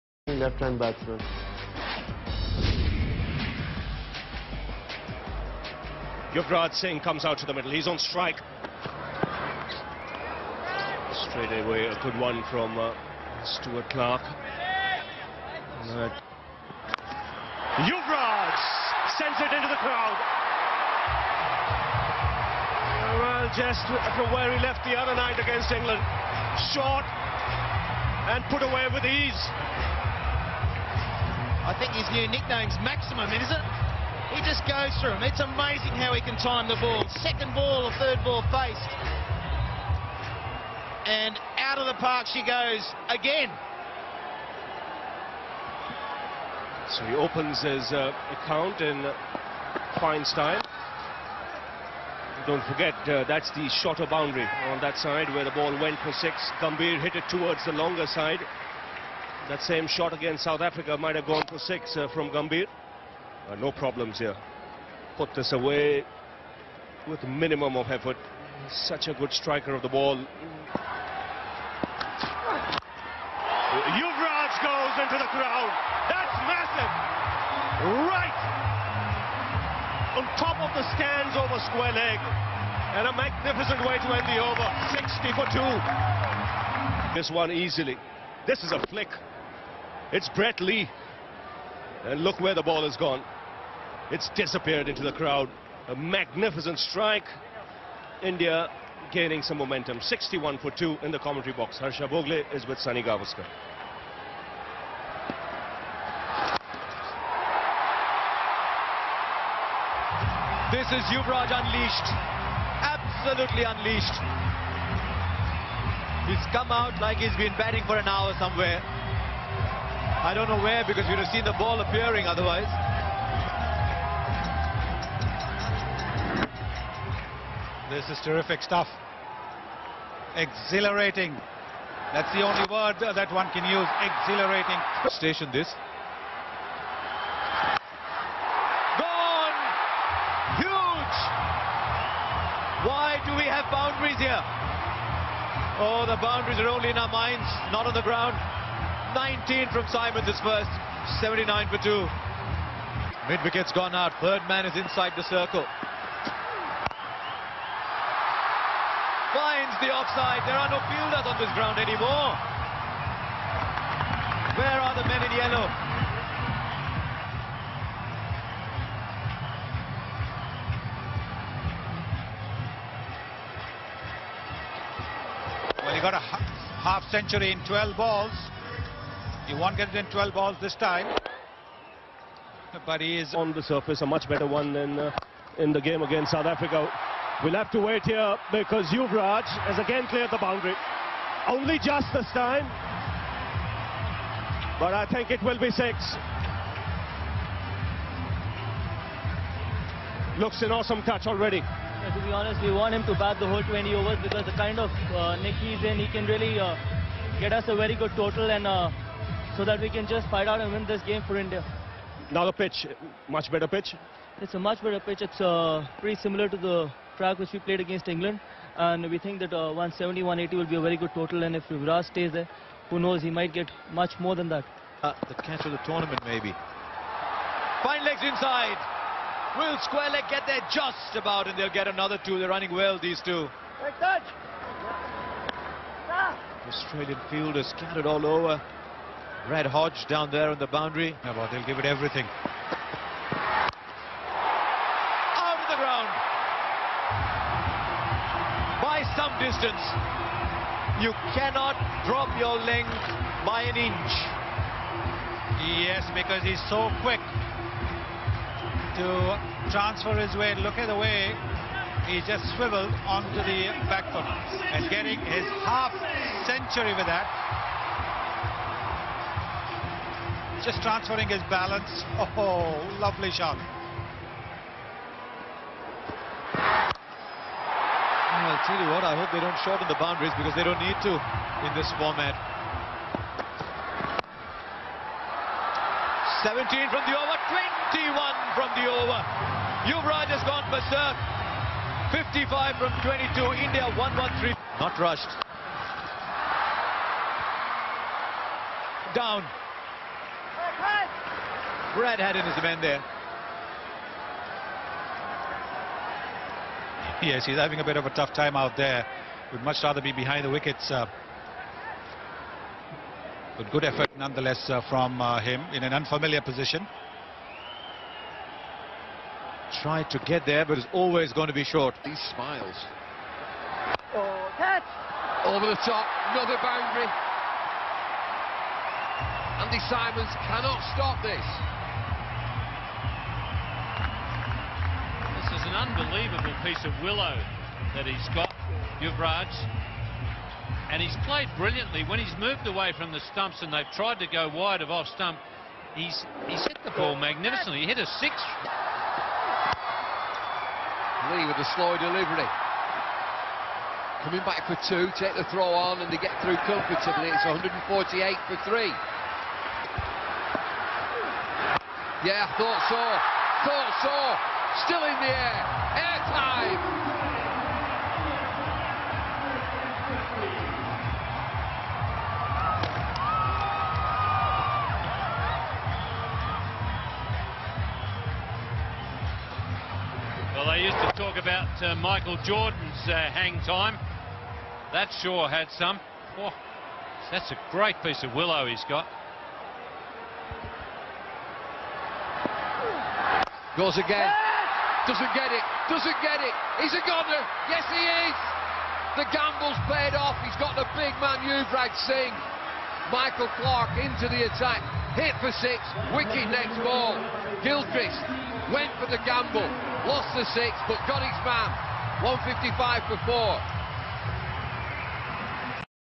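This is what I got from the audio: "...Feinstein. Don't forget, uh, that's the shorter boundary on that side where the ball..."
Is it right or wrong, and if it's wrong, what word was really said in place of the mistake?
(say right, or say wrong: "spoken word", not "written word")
right.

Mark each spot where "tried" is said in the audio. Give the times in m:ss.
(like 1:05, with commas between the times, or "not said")
5:19, 5:43.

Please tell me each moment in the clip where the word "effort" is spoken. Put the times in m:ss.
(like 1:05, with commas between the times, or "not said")
1:07, 5:13.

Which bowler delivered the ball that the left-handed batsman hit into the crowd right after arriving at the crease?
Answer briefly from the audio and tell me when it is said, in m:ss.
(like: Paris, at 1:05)
Stuart Clark, at 0:13.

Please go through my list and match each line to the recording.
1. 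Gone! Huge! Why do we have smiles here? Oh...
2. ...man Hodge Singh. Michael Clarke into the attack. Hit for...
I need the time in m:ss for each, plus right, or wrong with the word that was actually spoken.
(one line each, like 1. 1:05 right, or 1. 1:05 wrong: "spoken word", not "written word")
1. 2:19 wrong: "boundaries", not "smiles"
2. 6:41 wrong: "Yuvraj", not "Hodge".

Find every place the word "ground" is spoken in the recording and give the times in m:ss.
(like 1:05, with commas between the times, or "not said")
2:28, 2:41, 4:05.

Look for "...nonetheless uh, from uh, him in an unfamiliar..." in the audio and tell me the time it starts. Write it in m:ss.
5:14.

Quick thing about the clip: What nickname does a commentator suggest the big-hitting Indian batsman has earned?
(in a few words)
Maximum.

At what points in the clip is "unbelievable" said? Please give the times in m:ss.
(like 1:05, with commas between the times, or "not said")
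5:35.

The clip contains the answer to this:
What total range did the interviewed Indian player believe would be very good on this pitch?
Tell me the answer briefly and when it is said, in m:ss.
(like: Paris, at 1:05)
170 to 180, at 3:39.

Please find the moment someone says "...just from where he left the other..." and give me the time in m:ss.
0:23.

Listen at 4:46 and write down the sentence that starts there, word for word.
17 from the over, 21 from the over.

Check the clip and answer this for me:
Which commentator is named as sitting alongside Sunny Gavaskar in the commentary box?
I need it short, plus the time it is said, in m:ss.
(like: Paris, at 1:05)
Harsha Bhogle, at 1:41.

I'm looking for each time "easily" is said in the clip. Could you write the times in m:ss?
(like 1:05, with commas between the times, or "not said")
1:27.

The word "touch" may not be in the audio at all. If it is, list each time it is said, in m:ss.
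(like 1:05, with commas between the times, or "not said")
3:21, 3:53.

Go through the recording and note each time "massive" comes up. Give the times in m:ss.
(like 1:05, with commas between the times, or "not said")
1:16.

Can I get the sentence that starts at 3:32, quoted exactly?
Now the pitch, much better pitch?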